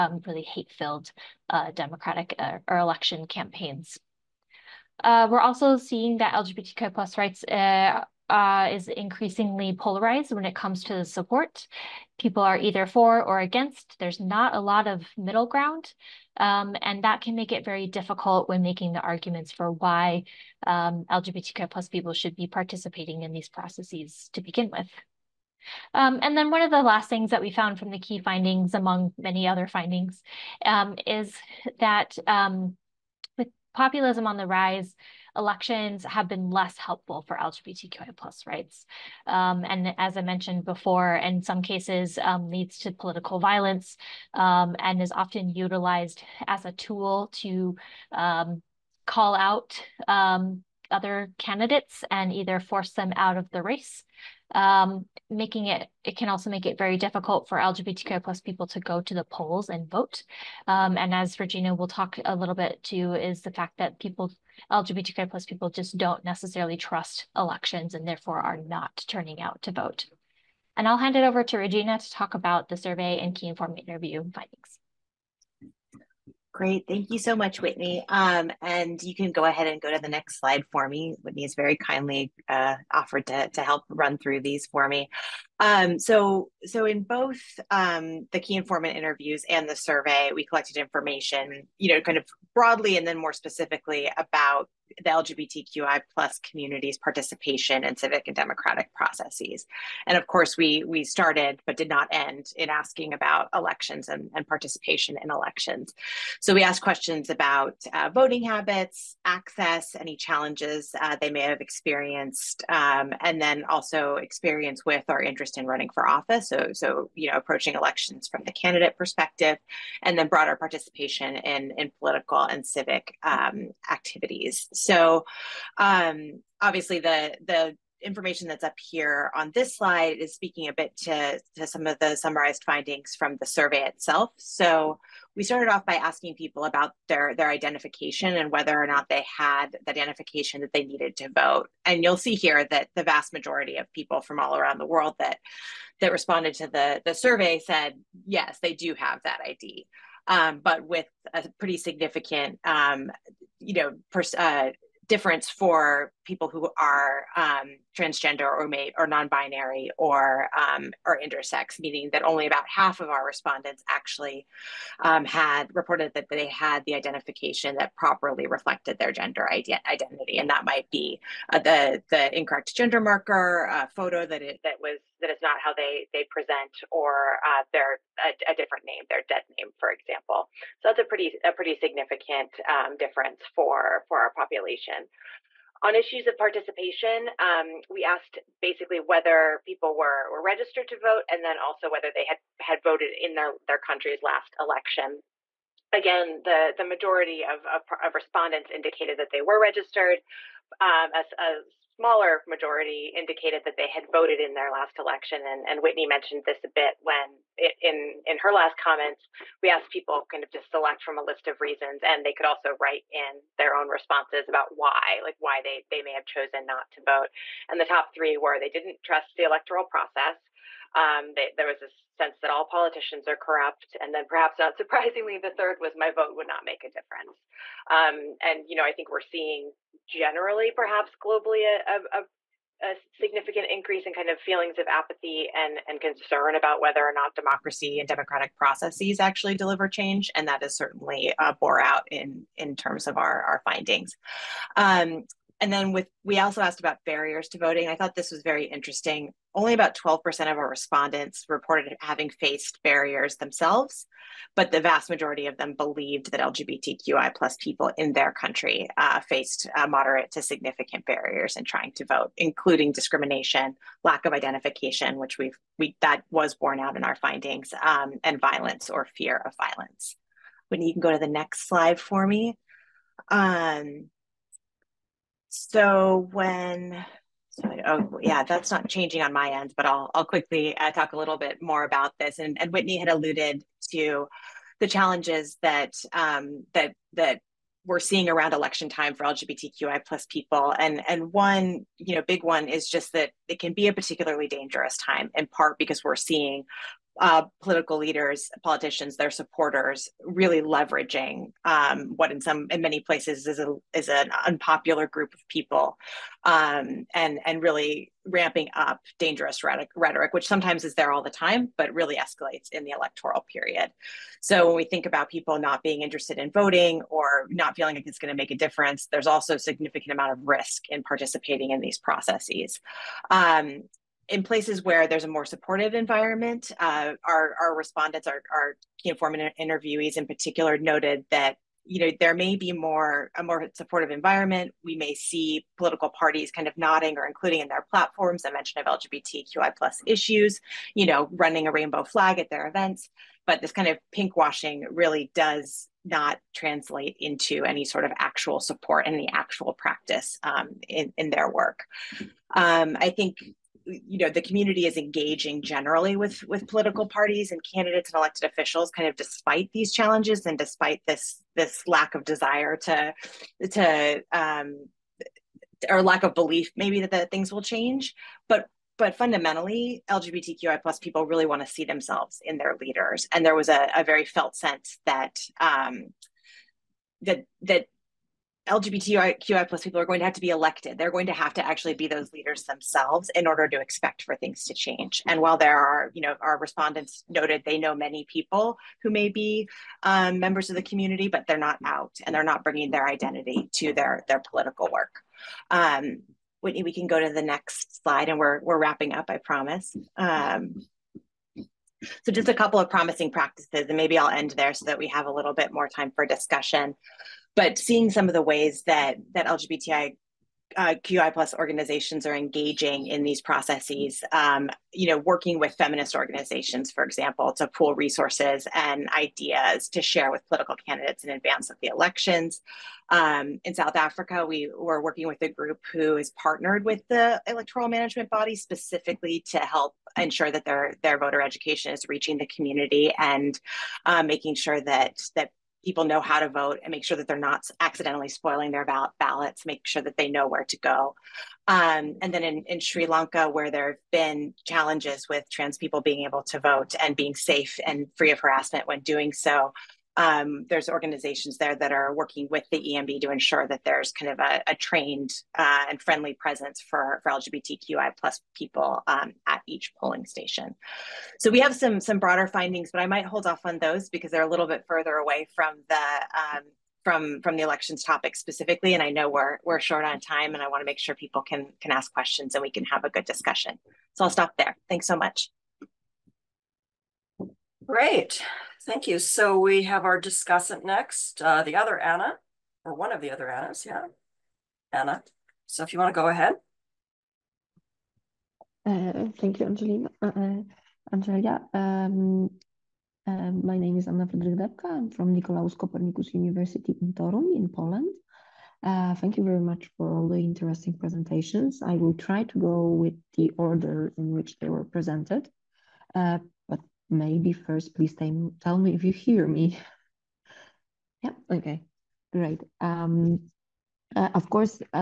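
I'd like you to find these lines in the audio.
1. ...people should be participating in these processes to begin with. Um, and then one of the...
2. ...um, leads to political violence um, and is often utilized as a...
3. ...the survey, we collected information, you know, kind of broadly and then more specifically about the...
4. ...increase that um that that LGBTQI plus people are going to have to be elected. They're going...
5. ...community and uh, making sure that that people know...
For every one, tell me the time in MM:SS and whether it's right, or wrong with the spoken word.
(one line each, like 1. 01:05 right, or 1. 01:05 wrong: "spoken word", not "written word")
1. 00:21 right
2. 00:42 right
3. 01:29 right
4. 06:14 wrong: "sense", not "increase"
5. 07:12 right.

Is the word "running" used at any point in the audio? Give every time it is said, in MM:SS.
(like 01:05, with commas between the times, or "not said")
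01:55, 05:41.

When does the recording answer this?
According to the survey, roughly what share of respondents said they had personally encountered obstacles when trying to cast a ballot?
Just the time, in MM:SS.
04:09.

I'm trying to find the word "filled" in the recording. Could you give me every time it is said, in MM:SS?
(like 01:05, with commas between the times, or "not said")
00:00.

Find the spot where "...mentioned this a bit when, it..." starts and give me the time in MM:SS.
03:26.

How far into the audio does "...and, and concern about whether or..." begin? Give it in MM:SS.
03:55.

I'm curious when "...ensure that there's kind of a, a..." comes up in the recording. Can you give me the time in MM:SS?
07:33.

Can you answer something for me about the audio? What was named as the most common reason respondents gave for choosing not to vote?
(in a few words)
didn't trust the electoral process.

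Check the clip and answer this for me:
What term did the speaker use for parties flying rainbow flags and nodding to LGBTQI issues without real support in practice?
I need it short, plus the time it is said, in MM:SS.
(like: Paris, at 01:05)
pink washing, at 05:44.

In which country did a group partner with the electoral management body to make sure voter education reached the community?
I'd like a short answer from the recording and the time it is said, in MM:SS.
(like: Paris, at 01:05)
South Africa, at 07:03.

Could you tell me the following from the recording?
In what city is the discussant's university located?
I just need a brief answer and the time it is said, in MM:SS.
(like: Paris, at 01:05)
Torun, at 08:17.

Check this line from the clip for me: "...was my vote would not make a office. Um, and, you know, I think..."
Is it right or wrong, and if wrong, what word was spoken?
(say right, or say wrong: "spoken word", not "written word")
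wrong: "difference", not "office".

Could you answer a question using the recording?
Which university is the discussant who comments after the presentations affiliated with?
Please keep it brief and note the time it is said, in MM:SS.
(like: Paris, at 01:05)
Nicolaus Copernicus University, at 08:15.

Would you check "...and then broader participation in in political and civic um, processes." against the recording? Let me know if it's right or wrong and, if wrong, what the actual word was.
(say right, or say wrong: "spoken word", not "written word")
wrong: "activities", not "processes".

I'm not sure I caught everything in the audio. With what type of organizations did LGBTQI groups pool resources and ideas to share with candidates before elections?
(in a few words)
feminist organizations.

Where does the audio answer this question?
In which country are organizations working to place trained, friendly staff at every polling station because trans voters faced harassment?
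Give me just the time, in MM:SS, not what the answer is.
07:22.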